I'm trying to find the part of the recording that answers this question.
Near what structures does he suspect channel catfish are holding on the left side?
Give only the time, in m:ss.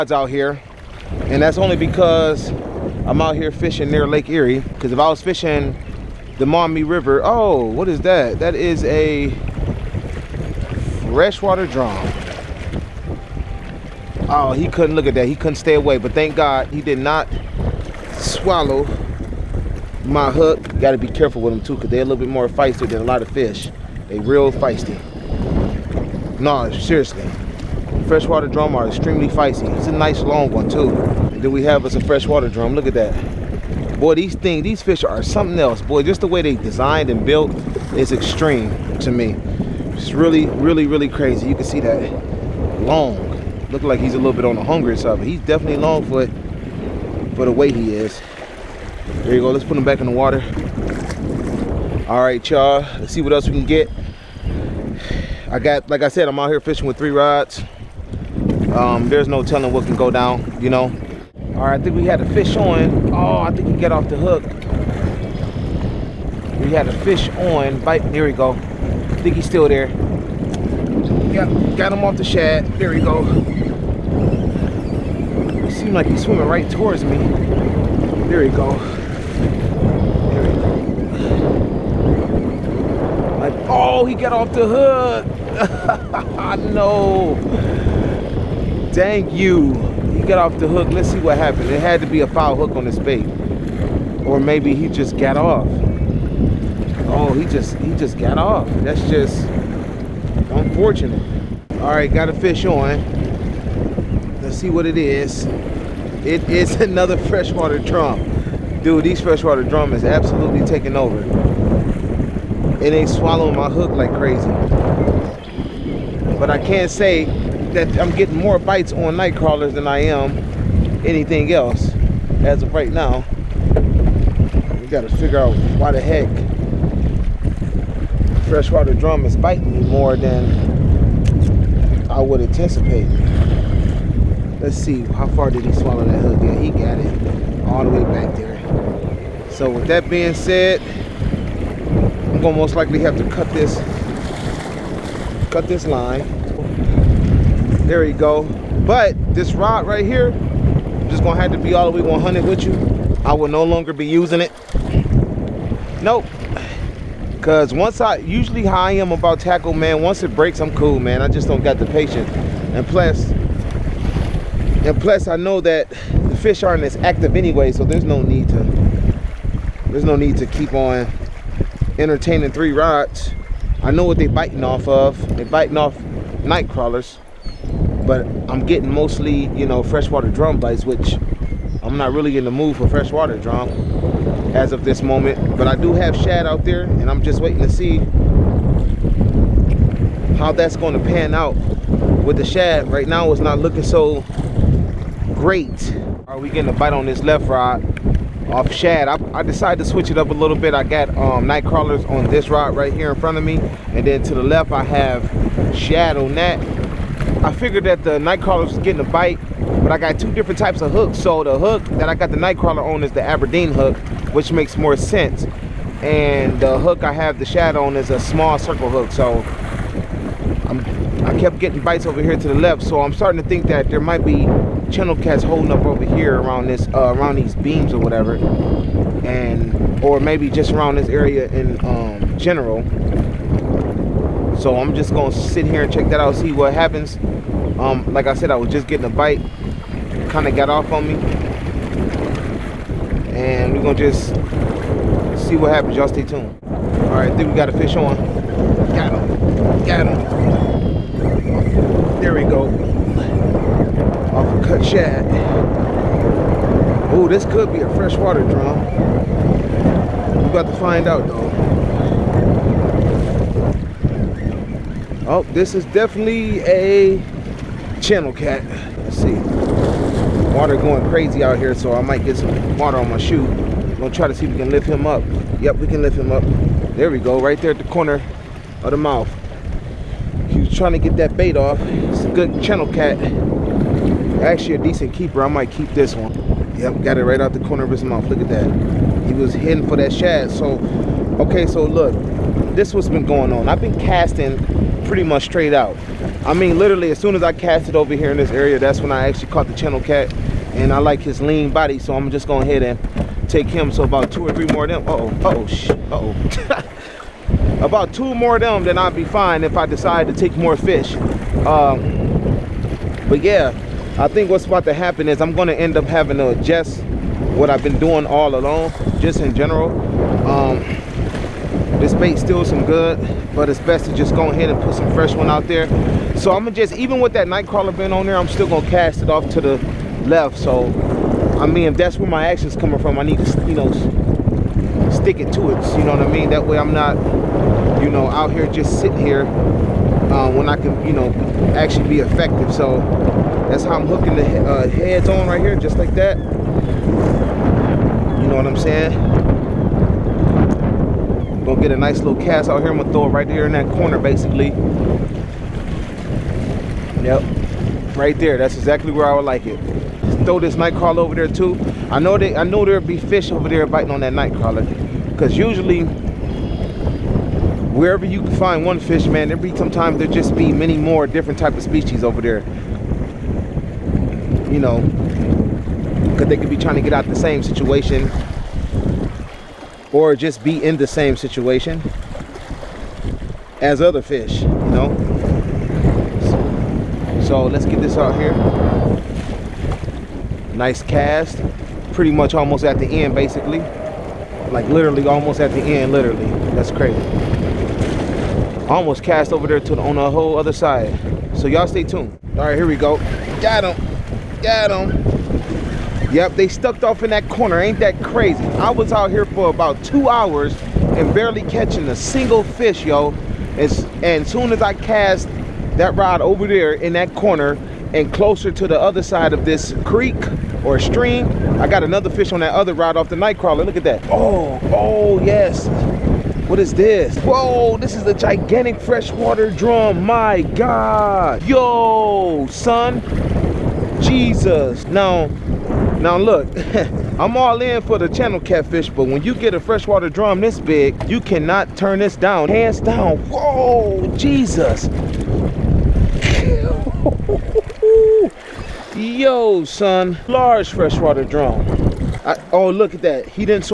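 3:47.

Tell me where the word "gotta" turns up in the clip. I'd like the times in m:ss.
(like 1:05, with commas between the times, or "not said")
0:20, 2:04.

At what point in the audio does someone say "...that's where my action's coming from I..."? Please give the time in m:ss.
5:31.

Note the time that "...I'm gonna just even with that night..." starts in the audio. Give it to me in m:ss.
5:26.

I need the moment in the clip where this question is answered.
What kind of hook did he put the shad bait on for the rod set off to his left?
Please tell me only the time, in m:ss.
3:38.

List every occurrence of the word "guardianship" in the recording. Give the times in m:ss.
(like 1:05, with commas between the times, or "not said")
not said.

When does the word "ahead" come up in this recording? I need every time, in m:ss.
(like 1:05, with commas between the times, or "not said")
5:02, 5:24.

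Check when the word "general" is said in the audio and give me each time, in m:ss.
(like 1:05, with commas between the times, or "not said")
3:52, 5:19.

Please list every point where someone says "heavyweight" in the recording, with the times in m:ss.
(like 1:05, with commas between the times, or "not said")
not said.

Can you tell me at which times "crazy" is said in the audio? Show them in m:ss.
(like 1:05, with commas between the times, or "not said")
0:41, 1:54, 4:31, 6:36, 6:48.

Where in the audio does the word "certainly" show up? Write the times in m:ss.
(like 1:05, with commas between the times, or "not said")
not said.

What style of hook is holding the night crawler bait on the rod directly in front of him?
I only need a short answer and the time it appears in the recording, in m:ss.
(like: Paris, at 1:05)
Aberdeen hook, at 3:33.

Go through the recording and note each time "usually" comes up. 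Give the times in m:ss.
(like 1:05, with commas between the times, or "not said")
2:38, 6:05.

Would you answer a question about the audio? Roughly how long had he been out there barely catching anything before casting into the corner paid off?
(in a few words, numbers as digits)
About 2 hours.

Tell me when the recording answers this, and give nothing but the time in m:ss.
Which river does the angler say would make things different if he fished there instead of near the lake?
0:06.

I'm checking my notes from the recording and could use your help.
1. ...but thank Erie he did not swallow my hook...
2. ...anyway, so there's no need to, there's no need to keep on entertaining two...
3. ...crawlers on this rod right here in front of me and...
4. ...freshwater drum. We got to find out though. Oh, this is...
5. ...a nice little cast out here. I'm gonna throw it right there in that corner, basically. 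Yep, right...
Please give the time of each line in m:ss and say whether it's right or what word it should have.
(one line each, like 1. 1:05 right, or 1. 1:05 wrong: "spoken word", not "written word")
1. 0:15 wrong: "God", not "Erie"
2. 2:47 wrong: "three", not "two"
3. 3:21 right
4. 4:17 right
5. 5:51 right.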